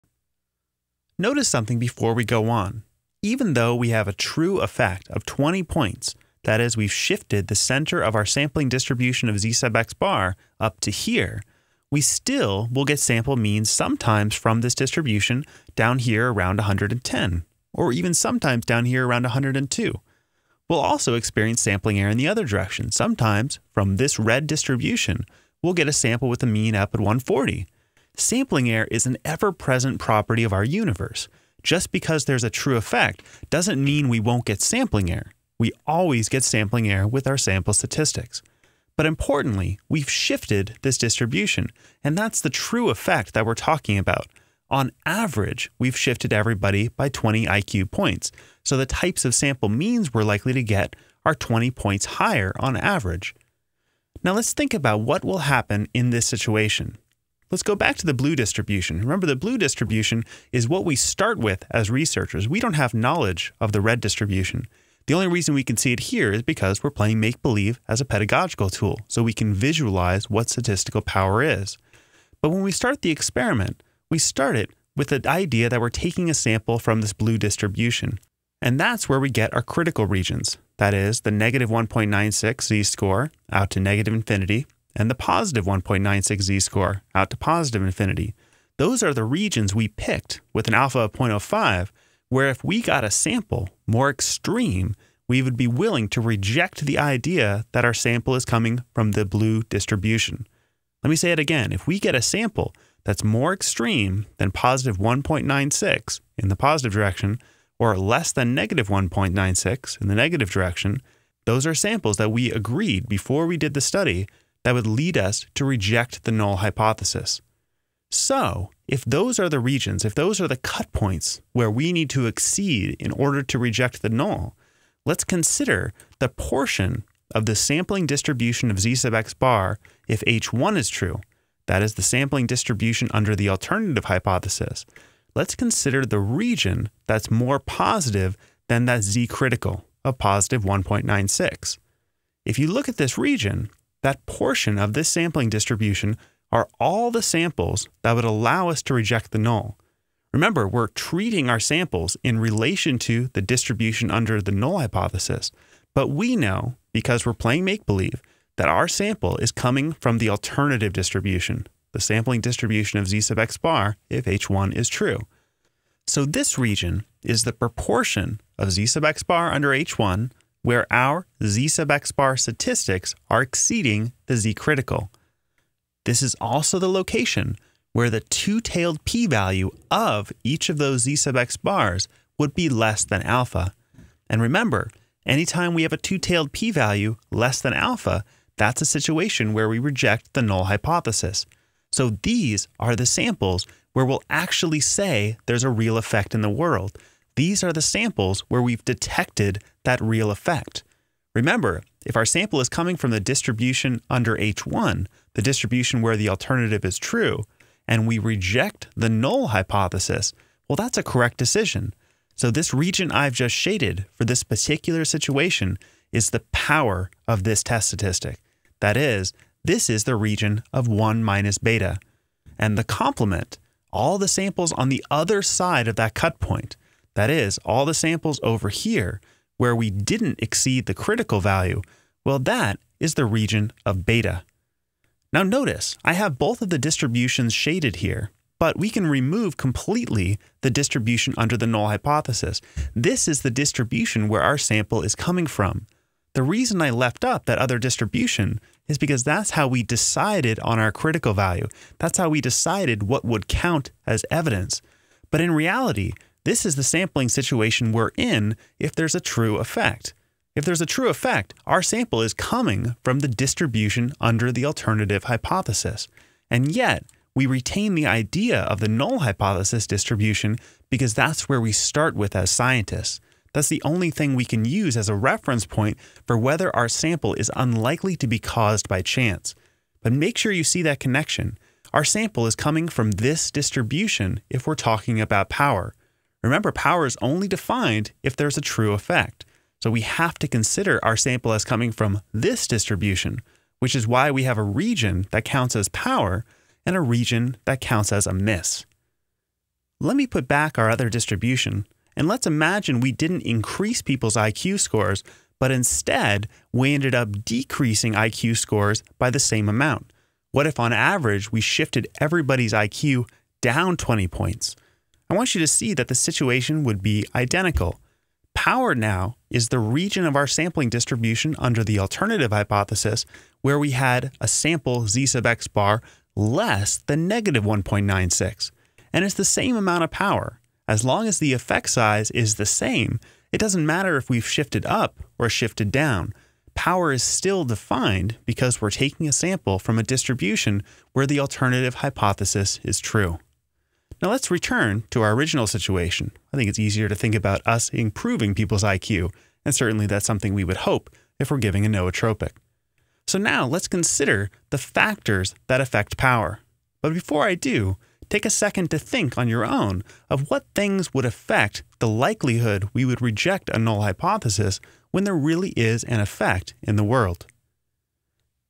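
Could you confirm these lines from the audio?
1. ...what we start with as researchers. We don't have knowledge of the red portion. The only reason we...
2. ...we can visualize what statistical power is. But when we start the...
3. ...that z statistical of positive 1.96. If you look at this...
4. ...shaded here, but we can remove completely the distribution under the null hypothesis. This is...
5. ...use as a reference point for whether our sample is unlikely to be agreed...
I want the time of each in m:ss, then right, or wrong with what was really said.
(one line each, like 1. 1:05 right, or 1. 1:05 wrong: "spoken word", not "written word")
1. 1:00 wrong: "distribution", not "portion"
2. 1:09 right
3. 2:18 wrong: "critical", not "statistical"
4. 3:57 right
5. 4:34 wrong: "caused", not "agreed".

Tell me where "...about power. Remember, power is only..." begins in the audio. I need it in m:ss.
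4:45.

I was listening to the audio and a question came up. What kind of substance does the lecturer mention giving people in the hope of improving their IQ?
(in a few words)
nootropic.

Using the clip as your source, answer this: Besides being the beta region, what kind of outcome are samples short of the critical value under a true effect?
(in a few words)
a miss.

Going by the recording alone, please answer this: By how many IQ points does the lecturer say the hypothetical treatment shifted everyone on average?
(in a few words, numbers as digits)
20.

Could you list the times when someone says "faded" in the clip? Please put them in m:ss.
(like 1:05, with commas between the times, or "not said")
not said.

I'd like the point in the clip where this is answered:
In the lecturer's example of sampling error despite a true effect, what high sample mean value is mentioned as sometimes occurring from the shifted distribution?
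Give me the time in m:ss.
0:26.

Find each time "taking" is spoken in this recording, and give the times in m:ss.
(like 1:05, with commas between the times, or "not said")
1:15, 5:38.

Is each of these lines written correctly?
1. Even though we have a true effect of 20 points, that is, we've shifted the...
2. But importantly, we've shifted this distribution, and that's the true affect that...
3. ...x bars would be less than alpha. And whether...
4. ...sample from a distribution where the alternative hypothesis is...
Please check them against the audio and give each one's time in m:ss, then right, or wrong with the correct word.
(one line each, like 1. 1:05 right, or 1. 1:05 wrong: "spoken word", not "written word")
1. 0:03 right
2. 0:38 wrong: "effect", not "affect"
3. 3:01 wrong: "remember", not "whether"
4. 5:39 right.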